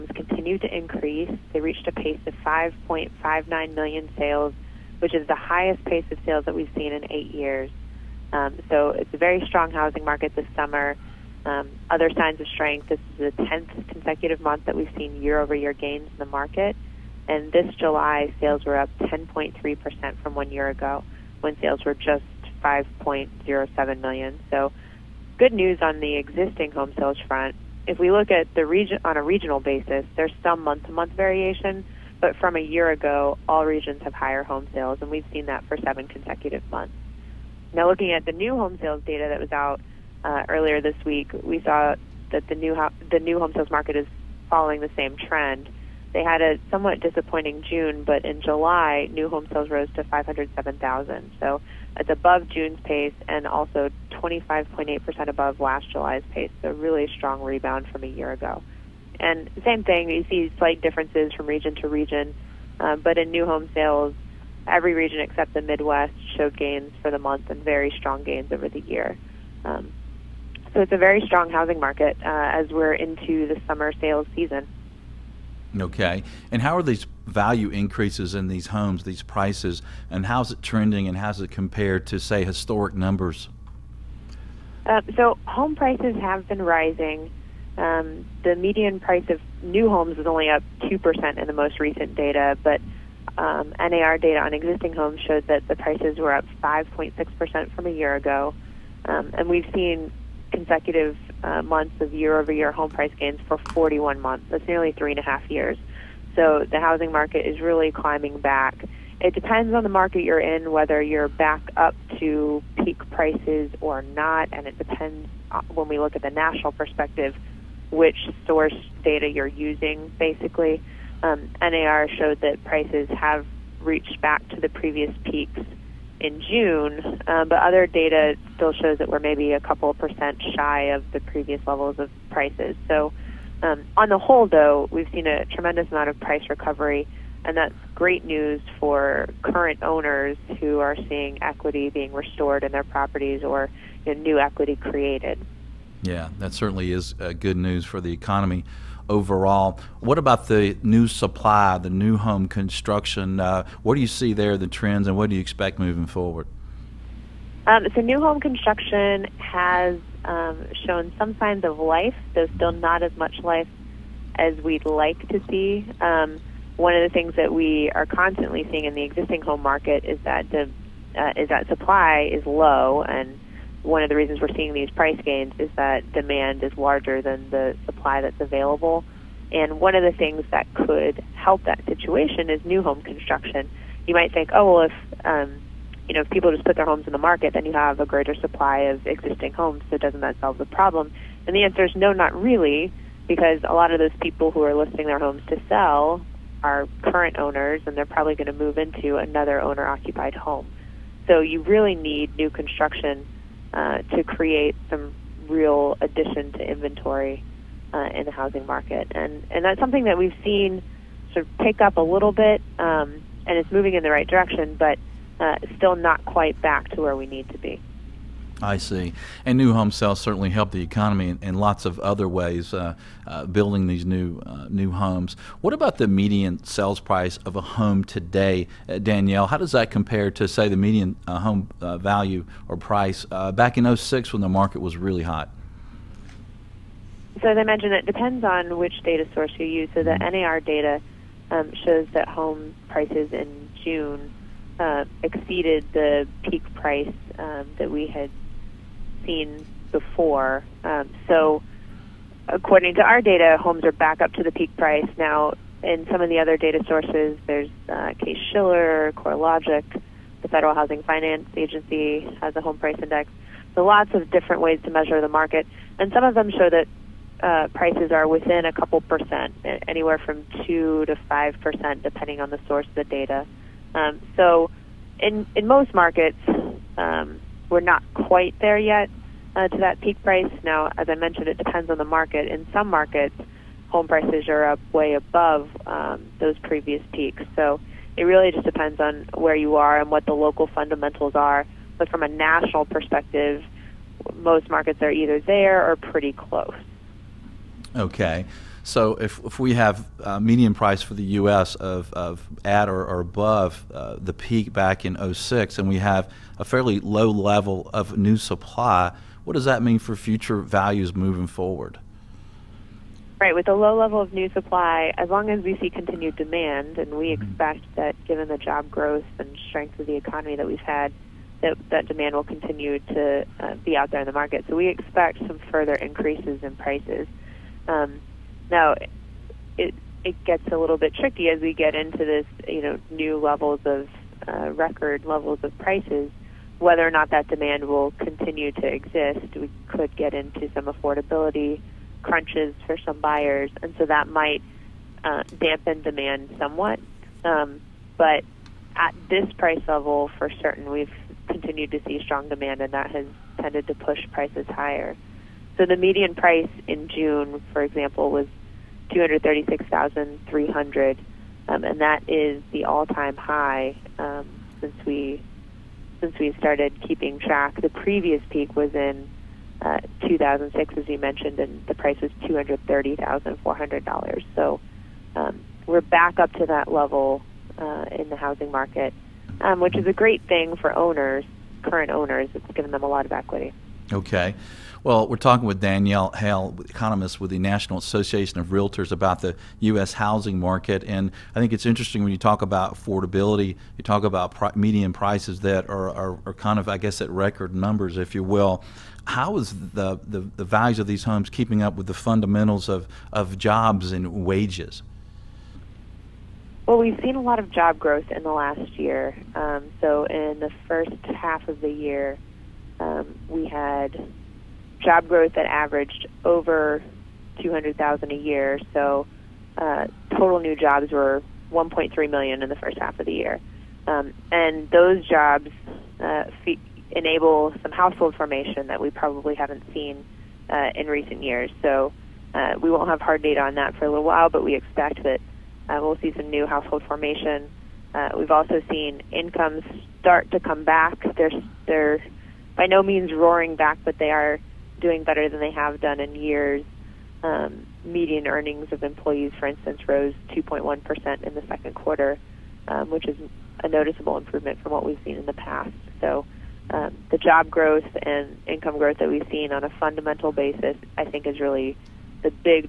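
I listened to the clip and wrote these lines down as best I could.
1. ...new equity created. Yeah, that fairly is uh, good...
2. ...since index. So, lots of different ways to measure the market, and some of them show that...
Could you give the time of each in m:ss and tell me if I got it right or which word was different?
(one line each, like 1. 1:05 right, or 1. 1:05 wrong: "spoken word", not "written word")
1. 2:24 wrong: "certainly", not "fairly"
2. 4:22 wrong: "price", not "since".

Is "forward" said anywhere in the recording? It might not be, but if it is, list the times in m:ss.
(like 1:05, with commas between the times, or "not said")
2:36, 5:11.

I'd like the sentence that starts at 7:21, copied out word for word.
They're they're by no means roaring back, but they are doing better than they have done in years.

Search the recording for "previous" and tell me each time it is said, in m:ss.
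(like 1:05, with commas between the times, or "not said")
2:04, 2:11, 4:46, 6:07.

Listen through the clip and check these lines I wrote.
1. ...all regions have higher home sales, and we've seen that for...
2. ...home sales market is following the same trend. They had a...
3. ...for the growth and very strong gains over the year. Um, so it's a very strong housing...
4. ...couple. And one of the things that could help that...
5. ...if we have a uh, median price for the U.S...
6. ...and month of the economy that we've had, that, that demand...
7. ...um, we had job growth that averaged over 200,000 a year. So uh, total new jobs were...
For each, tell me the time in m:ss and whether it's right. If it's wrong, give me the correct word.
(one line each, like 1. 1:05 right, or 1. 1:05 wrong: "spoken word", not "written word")
1. 0:33 right
2. 0:43 right
3. 1:07 wrong: "month", not "growth"
4. 2:58 wrong: "available", not "couple"
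5. 4:59 right
6. 5:19 wrong: "strength", not "month"
7. 6:52 right.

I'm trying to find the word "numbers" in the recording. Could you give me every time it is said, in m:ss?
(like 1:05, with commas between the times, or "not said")
1:22, 6:37.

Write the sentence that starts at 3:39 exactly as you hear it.
And new home sales certainly help the economy in, in lots of other ways, uh, uh, building these new uh, new homes.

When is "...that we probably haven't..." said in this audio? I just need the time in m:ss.
7:08.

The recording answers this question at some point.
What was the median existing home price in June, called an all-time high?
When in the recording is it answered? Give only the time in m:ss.
5:59.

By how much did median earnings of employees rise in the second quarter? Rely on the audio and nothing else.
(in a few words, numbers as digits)
2.1%.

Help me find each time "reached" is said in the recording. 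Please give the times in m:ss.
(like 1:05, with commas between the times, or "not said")
0:01, 2:03.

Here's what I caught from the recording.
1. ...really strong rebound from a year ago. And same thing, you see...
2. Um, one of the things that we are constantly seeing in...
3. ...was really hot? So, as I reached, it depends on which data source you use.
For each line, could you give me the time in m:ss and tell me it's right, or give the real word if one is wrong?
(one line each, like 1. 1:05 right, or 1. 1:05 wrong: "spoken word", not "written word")
1. 0:56 right
2. 2:46 right
3. 3:54 wrong: "mentioned", not "reached".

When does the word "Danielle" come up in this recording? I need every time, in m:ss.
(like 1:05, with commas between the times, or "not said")
3:48, 6:25.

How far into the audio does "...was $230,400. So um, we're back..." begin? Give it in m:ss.
6:12.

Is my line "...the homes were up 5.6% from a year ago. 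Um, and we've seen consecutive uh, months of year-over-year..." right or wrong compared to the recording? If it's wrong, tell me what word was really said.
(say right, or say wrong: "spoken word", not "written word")
wrong: "prices", not "homes".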